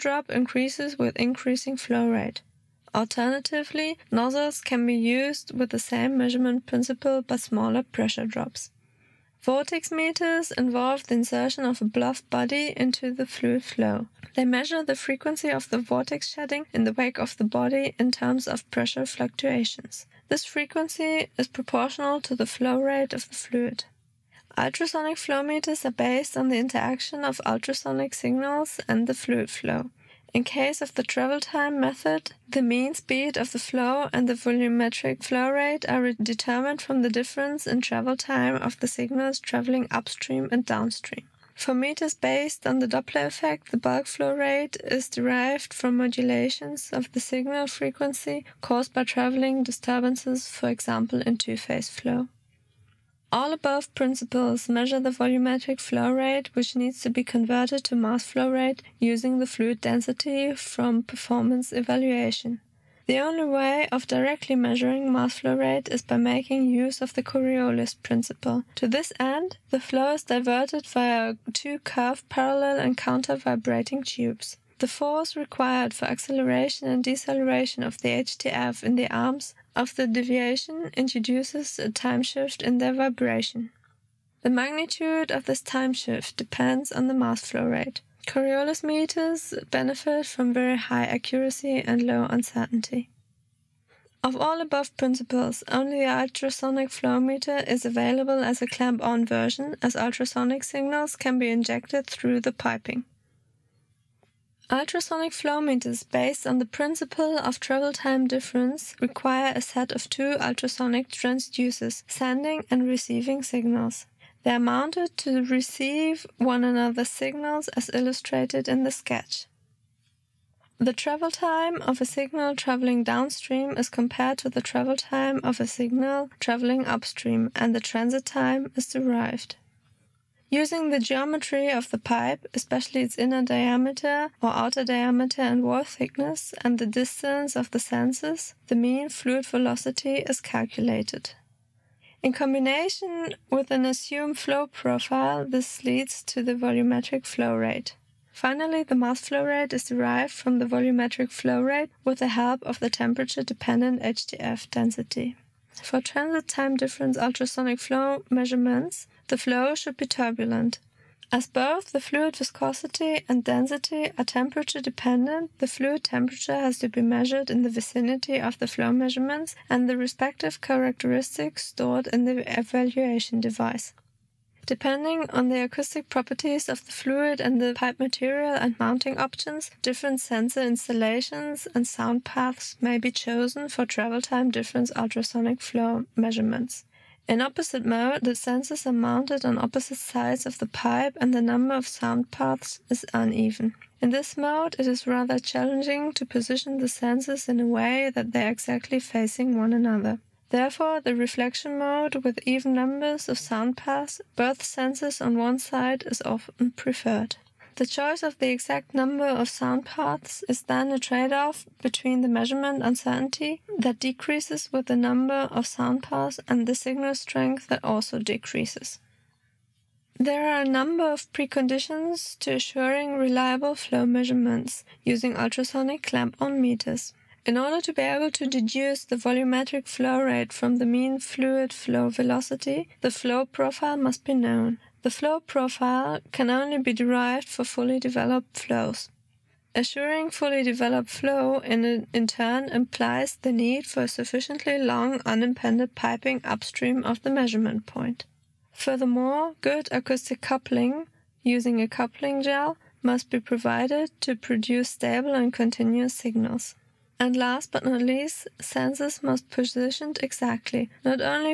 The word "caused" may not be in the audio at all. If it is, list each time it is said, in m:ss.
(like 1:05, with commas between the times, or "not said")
0:48.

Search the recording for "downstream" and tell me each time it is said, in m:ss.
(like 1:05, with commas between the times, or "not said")
0:40, 2:03.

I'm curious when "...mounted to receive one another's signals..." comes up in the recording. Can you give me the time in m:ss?
1:54.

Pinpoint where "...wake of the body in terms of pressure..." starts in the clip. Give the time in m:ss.
0:16.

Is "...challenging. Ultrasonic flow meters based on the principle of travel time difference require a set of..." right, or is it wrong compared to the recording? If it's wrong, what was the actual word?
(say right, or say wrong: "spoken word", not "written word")
wrong: "piping", not "challenging".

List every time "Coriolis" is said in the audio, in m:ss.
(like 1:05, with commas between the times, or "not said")
1:07, 1:28.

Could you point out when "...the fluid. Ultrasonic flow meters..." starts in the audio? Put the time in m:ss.
0:23.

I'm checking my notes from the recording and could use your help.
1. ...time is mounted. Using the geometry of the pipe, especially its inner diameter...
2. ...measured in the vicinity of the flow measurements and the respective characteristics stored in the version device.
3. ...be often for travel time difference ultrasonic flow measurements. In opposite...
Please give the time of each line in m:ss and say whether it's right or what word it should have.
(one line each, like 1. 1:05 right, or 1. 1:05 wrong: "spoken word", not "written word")
1. 2:08 wrong: "derived", not "mounted"
2. 2:47 wrong: "evaluation", not "version"
3. 3:02 wrong: "chosen", not "often".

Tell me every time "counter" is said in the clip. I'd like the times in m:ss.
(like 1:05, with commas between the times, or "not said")
1:12.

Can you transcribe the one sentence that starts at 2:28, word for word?
Finally, the mass flow rate is derived from the volumetric flow rate with the help of the temperature dependent HTF density.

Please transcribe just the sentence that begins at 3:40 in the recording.
There are a number of preconditions to assuring reliable flow measurements using ultrasonic clamp-on meters.